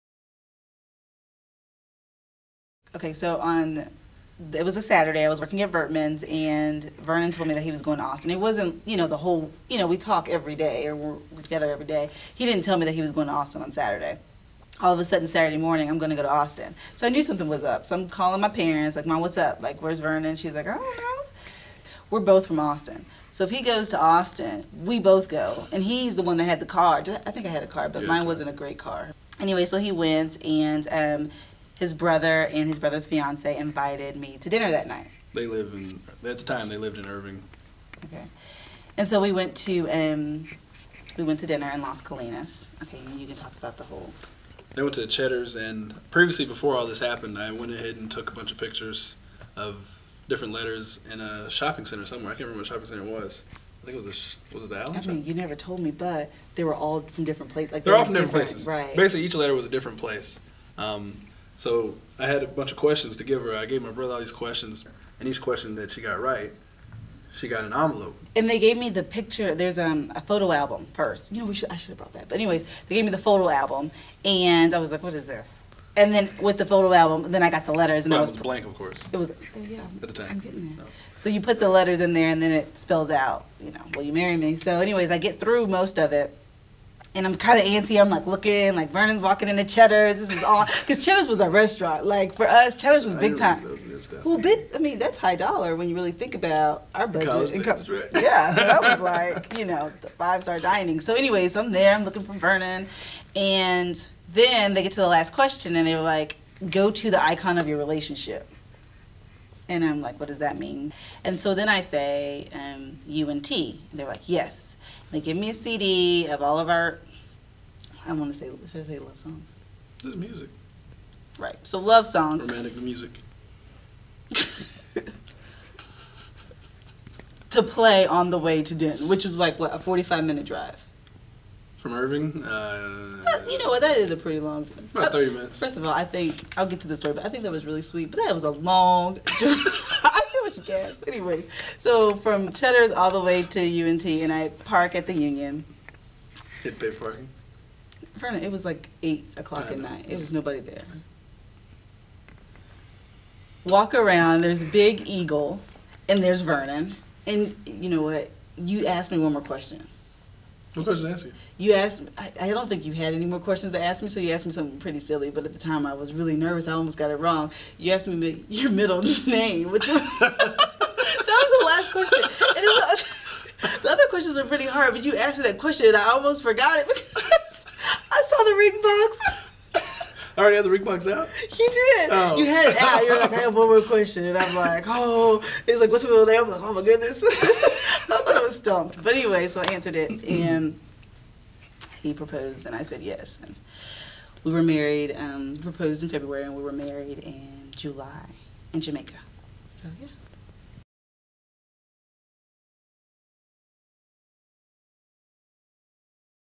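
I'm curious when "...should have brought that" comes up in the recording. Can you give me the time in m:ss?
1:11.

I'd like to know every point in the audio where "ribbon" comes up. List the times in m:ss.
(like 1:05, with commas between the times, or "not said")
not said.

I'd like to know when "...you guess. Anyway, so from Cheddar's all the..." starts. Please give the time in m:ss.
2:20.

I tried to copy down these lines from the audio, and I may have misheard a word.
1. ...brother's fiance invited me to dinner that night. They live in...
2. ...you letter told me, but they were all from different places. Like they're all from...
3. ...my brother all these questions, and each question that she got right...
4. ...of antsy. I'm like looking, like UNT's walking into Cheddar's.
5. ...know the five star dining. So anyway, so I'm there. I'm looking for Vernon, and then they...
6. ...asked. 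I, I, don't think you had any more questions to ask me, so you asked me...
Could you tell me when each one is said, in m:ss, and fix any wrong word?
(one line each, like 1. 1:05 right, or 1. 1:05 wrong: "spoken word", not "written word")
1. 0:32 right
2. 0:55 wrong: "never", not "letter"
3. 1:03 right
4. 1:27 wrong: "Vernon", not "UNT"
5. 1:39 right
6. 2:41 right.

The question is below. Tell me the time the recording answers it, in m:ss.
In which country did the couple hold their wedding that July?
3:18.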